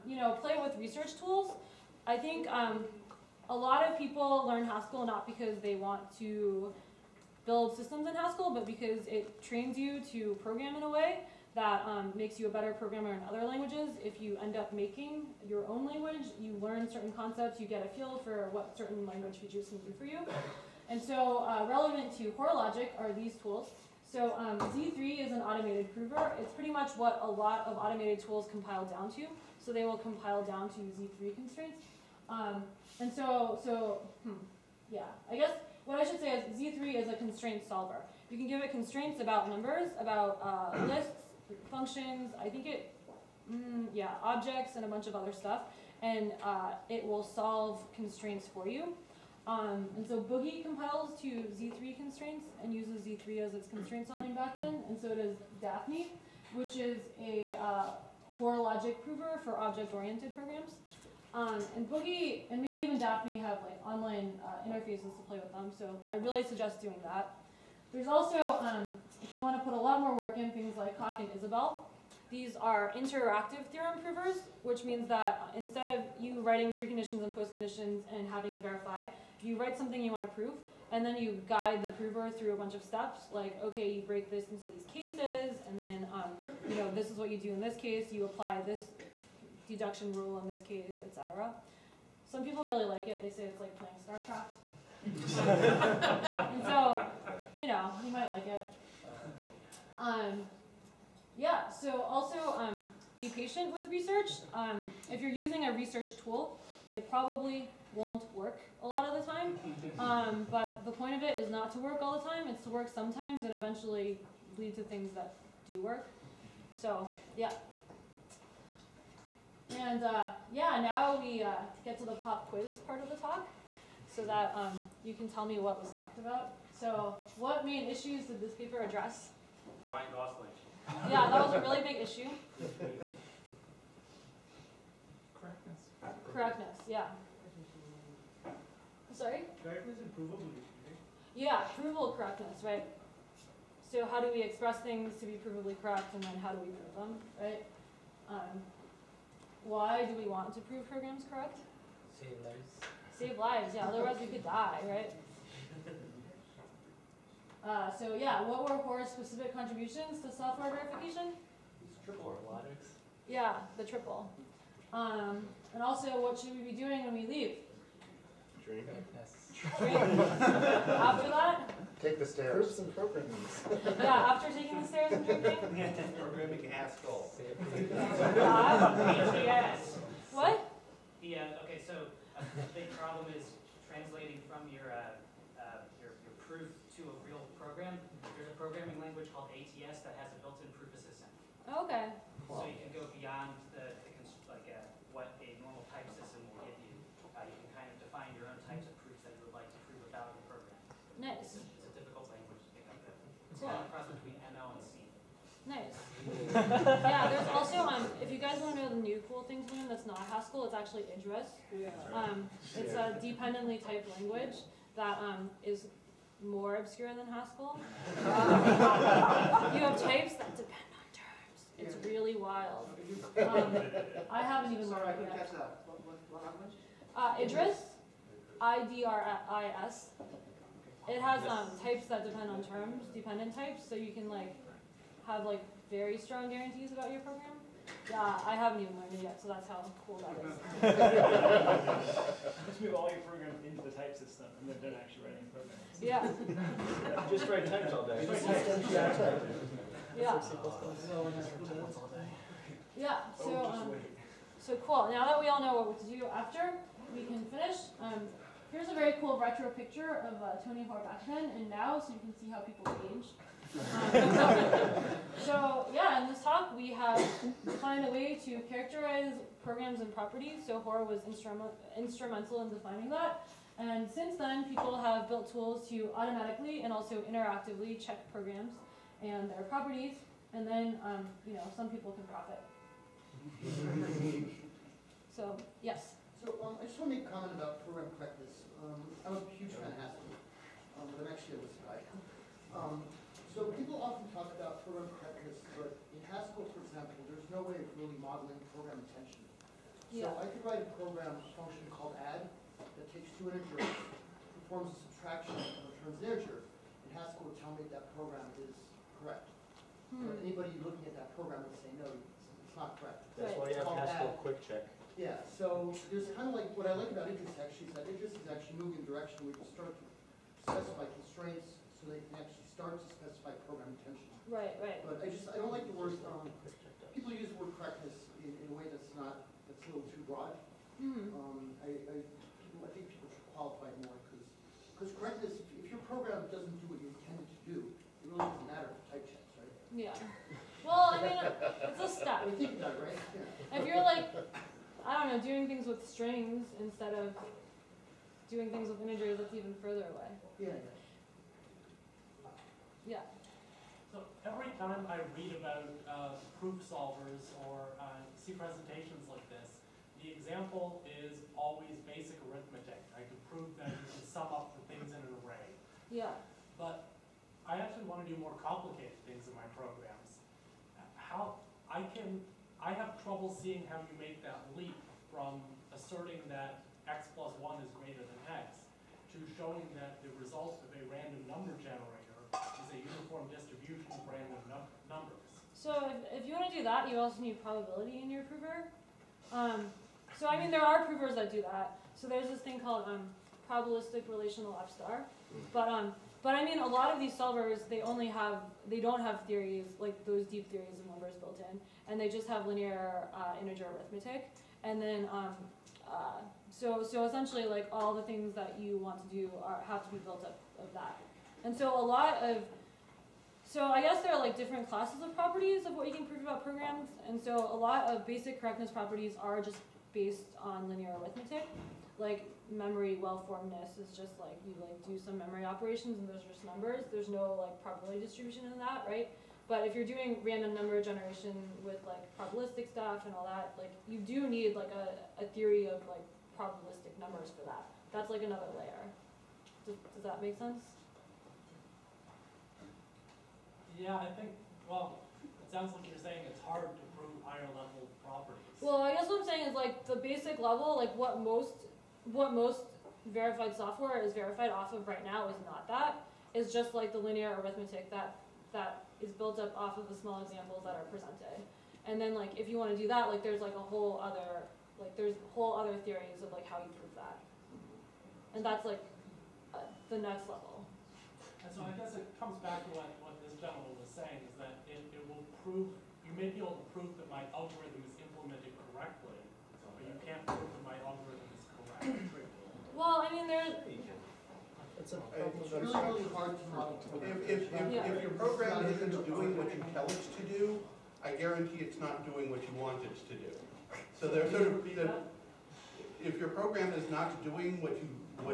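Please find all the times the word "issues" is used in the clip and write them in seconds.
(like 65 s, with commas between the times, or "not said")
127 s, 131 s.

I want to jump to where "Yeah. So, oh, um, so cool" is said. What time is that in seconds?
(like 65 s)
252 s.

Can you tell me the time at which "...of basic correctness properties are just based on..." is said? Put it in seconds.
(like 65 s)
418 s.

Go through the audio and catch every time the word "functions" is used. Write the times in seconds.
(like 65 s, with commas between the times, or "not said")
41 s, 301 s.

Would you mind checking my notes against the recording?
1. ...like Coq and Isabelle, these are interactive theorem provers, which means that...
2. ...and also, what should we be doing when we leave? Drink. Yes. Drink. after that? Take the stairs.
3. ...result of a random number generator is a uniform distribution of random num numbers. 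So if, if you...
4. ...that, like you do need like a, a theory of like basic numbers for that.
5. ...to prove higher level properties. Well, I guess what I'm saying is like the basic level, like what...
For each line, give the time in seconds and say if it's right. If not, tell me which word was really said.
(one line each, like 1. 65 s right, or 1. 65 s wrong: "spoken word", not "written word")
1. 70 s right
2. 165 s right
3. 380 s right
4. 433 s wrong: "probabilistic", not "basic"
5. 446 s right.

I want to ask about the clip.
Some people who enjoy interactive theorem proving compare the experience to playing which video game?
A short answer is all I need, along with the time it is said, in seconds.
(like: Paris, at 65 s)
StarCraft, at 94 s.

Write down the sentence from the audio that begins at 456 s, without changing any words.
It's just like the linear arithmetic that that is built up off of the small examples that are presented.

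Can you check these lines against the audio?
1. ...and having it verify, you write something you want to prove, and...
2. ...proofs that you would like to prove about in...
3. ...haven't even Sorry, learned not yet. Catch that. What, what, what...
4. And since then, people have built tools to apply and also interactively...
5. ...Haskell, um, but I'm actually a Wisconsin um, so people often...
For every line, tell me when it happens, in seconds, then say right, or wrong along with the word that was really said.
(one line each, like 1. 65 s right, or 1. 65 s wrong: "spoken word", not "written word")
1. 78 s right
2. 199 s right
3. 224 s right
4. 273 s wrong: "automatically", not "apply"
5. 289 s right.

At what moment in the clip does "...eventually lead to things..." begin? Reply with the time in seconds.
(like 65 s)
113 s.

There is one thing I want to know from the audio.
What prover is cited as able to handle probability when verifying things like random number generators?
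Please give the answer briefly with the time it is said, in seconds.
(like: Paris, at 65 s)
probabilistic relational F-star, at 393 s.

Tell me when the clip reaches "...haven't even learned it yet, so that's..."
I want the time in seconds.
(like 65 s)
238 s.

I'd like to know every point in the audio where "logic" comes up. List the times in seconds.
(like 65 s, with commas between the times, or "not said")
22 s, 58 s.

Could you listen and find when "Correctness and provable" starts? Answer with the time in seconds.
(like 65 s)
139 s.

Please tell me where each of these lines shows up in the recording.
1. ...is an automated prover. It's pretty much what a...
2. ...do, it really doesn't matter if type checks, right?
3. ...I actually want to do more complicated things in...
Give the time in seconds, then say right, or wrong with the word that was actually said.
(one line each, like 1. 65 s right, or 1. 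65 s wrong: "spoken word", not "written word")
1. 25 s right
2. 337 s right
3. 367 s right.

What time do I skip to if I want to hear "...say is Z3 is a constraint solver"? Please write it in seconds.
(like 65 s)
36 s.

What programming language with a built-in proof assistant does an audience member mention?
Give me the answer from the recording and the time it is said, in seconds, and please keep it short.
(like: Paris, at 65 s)
ATS, at 189 s.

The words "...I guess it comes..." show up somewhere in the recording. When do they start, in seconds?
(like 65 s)
471 s.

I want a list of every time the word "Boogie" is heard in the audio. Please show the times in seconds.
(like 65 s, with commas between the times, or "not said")
50 s, 61 s.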